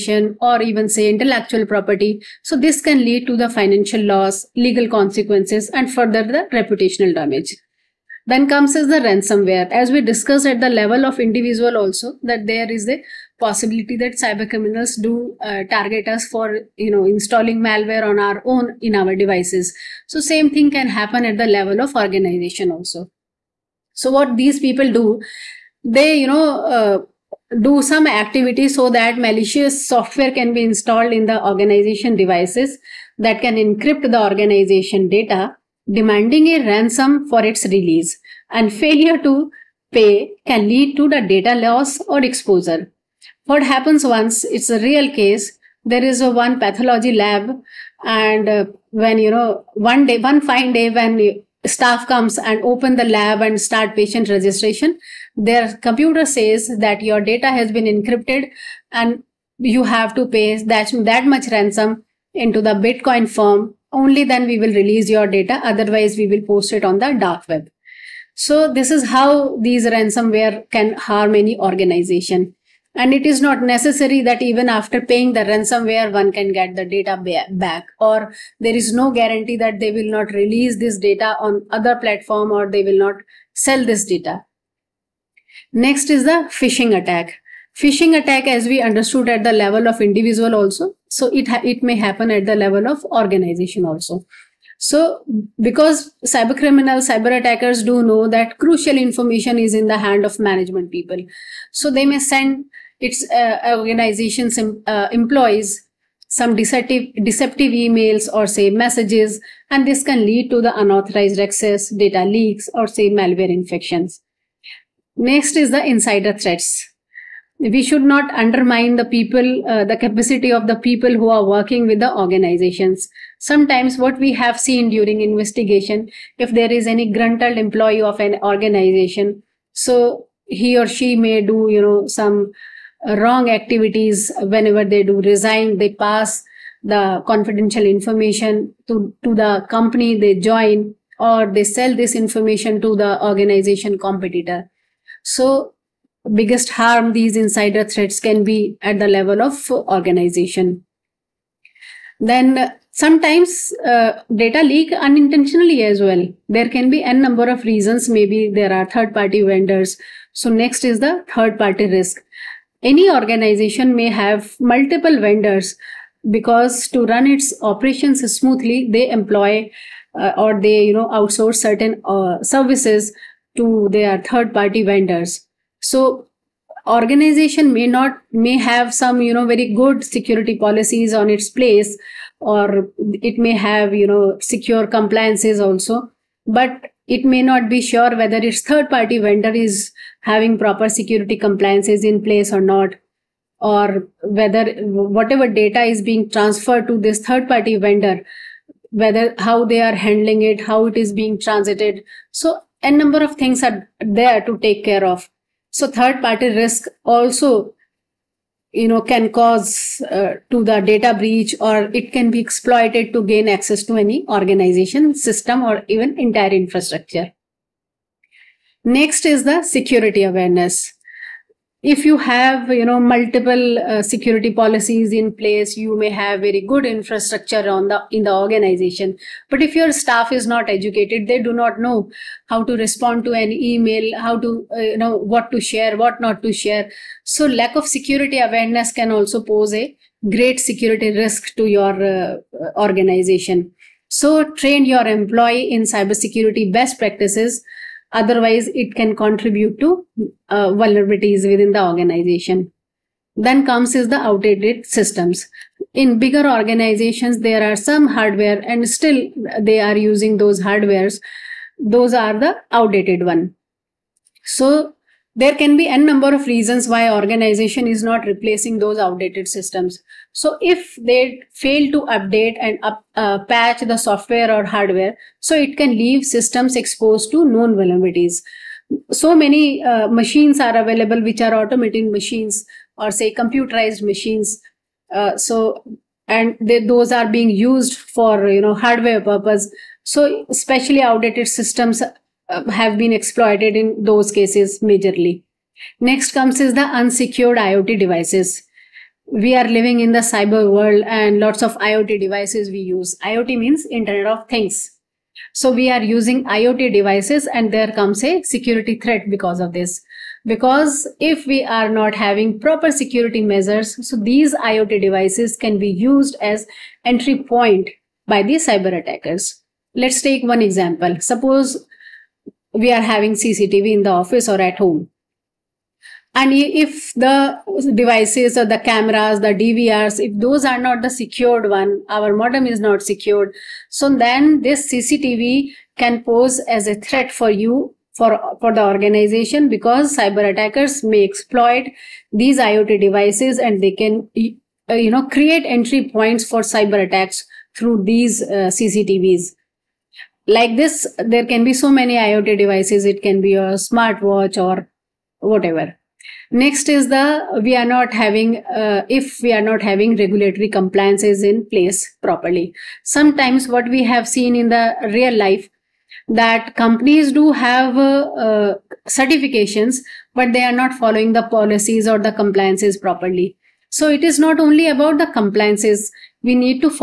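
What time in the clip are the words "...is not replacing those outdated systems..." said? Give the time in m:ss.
4:27.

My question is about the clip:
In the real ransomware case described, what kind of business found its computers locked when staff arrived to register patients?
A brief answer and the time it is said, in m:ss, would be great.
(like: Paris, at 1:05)
Pathology lab, at 0:46.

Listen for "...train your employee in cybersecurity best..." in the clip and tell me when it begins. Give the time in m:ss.
4:04.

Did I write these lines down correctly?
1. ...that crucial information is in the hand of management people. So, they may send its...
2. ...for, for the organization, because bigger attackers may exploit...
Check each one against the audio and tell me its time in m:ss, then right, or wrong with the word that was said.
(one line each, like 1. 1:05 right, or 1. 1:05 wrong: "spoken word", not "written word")
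1. 1:38 right
2. 5:38 wrong: "cyber", not "bigger".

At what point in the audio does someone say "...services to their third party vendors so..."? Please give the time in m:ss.
2:52.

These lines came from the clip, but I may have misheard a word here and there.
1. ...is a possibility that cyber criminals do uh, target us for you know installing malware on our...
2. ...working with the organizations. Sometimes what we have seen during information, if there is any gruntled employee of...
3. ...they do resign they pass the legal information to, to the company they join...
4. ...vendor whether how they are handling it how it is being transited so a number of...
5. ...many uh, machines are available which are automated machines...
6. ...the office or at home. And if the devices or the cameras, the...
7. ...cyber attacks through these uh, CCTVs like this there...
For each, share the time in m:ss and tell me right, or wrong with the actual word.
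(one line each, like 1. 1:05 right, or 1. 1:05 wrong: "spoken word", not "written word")
1. 0:12 right
2. 2:01 wrong: "investigation", not "information"
3. 2:14 wrong: "confidential", not "legal"
4. 3:17 right
5. 4:39 right
6. 5:24 right
7. 5:46 right.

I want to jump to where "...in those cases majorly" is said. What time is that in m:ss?
4:53.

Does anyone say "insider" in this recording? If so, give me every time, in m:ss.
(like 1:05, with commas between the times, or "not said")
1:55, 2:27.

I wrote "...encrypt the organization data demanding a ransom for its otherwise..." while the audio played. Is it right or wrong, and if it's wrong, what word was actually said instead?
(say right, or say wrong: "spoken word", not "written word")
wrong: "release", not "otherwise".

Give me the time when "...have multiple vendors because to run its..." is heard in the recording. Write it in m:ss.
2:44.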